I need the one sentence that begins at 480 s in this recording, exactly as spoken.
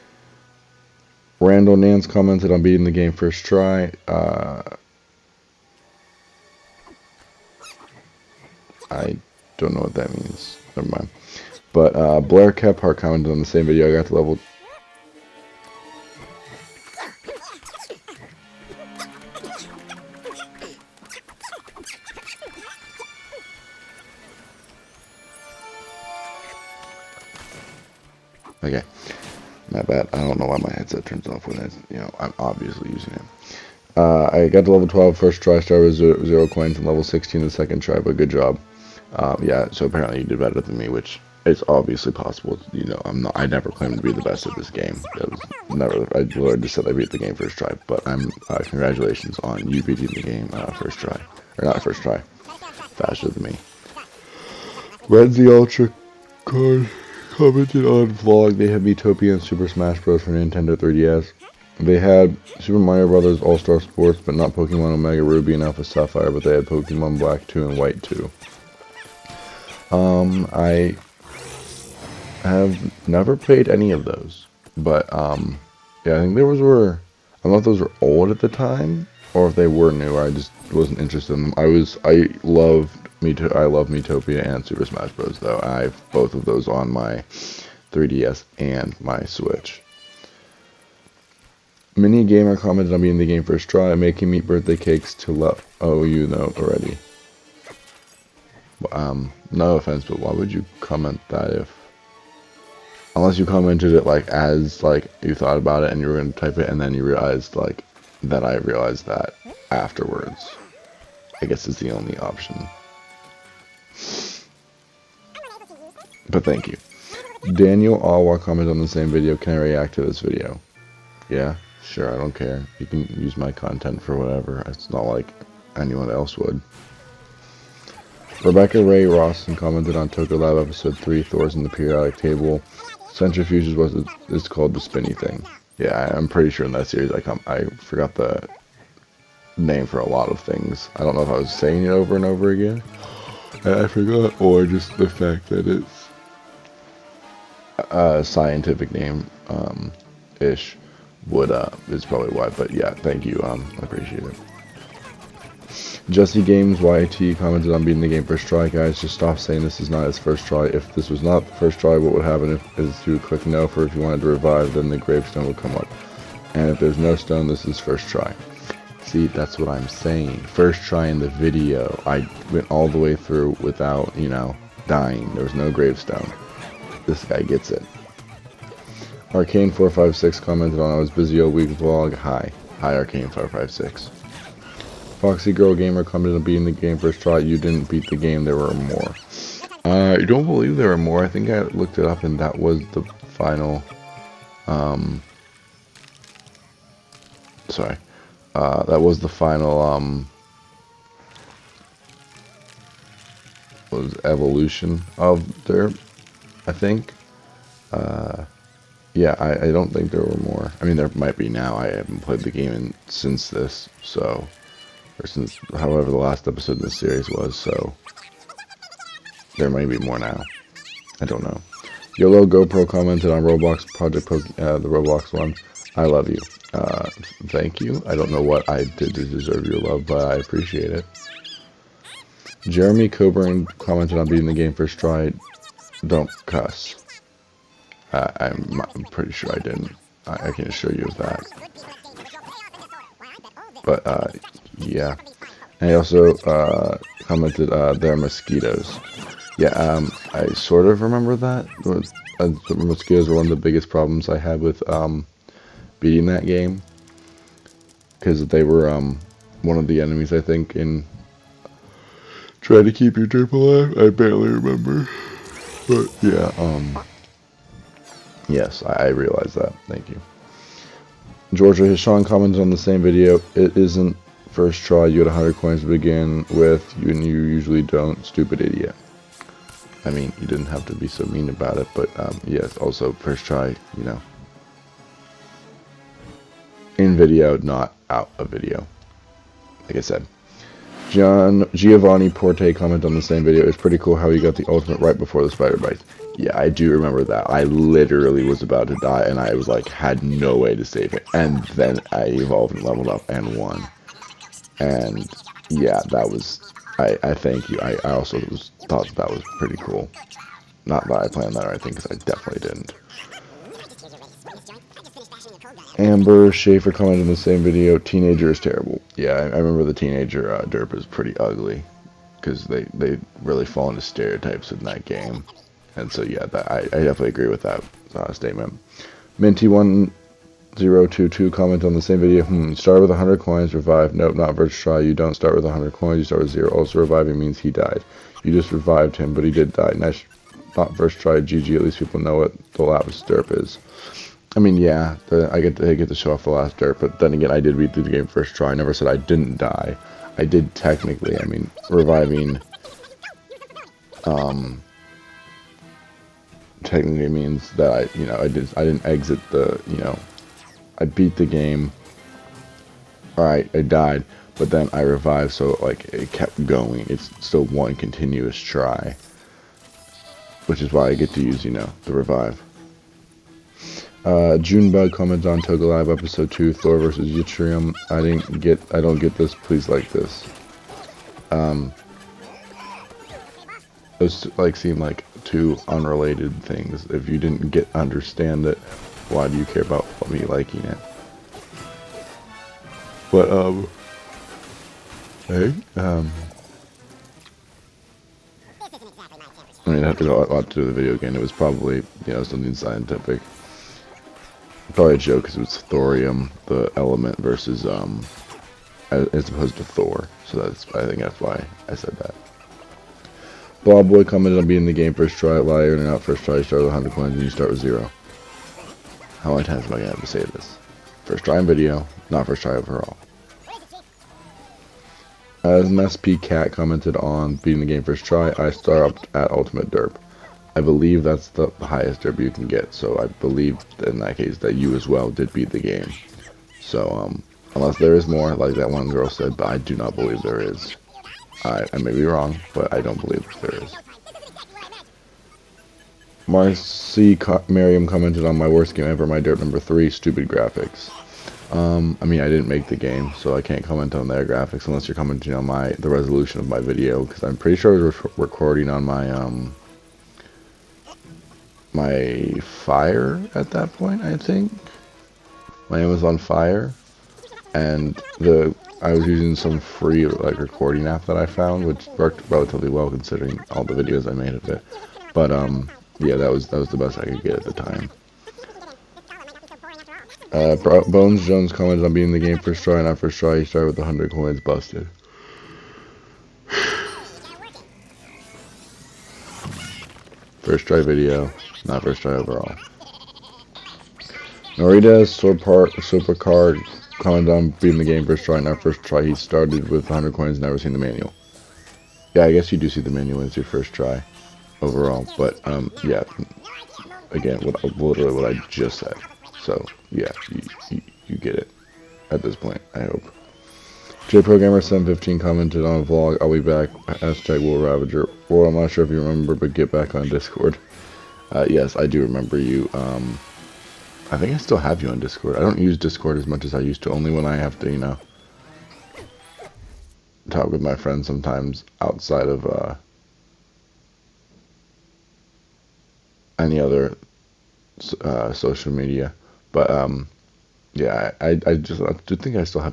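Uh, Bones Jones comments on being the game first try, not first try.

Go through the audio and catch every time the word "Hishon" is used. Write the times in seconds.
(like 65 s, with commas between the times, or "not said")
271 s.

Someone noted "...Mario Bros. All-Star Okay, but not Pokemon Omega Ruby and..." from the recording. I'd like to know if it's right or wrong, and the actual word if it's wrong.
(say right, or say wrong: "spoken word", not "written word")
wrong: "Sports", not "Okay".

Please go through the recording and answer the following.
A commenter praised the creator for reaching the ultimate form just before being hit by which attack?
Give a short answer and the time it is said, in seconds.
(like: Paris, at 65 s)
Spider bite, at 295 s.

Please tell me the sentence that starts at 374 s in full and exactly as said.
Uh, Junebug comments on Toca Lab episode two, Thor versus Yttrium.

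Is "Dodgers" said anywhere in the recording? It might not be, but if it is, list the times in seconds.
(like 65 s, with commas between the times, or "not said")
not said.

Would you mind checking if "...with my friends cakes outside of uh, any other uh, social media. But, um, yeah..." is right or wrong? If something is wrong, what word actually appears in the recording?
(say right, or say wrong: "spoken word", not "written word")
wrong: "sometimes", not "cakes".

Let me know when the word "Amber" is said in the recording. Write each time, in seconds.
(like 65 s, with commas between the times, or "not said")
315 s.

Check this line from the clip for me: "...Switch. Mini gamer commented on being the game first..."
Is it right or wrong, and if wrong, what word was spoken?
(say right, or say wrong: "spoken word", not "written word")
right.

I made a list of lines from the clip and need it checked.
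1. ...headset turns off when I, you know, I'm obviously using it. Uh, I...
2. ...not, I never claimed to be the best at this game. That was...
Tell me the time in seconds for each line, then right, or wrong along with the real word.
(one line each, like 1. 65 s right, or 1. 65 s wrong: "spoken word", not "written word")
1. 30 s right
2. 43 s right.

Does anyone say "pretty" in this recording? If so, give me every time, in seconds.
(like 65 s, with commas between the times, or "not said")
136 s, 239 s, 293 s, 309 s, 321 s, 457 s.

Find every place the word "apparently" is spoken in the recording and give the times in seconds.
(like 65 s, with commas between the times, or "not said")
39 s.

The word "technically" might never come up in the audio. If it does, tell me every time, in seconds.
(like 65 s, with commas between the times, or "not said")
350 s, 356 s.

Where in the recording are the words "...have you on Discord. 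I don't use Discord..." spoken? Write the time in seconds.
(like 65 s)
524 s.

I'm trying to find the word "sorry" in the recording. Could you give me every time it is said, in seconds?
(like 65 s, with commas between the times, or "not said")
197 s.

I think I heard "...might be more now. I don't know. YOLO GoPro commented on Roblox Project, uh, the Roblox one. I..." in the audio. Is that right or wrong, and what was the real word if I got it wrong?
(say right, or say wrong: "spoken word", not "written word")
right.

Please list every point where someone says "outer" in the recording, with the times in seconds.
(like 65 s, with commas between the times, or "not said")
not said.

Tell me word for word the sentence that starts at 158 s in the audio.
Guys, just stop saying this is not his first try.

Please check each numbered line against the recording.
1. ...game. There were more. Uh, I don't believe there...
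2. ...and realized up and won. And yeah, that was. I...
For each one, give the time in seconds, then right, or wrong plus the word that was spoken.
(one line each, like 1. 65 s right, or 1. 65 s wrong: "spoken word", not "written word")
1. 188 s right
2. 302 s wrong: "leveled", not "realized".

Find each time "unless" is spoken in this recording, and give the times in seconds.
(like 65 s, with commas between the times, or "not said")
103 s, 437 s, 454 s.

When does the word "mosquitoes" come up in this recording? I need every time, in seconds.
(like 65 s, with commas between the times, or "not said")
248 s, 252 s.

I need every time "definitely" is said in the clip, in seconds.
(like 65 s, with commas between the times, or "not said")
312 s, 327 s.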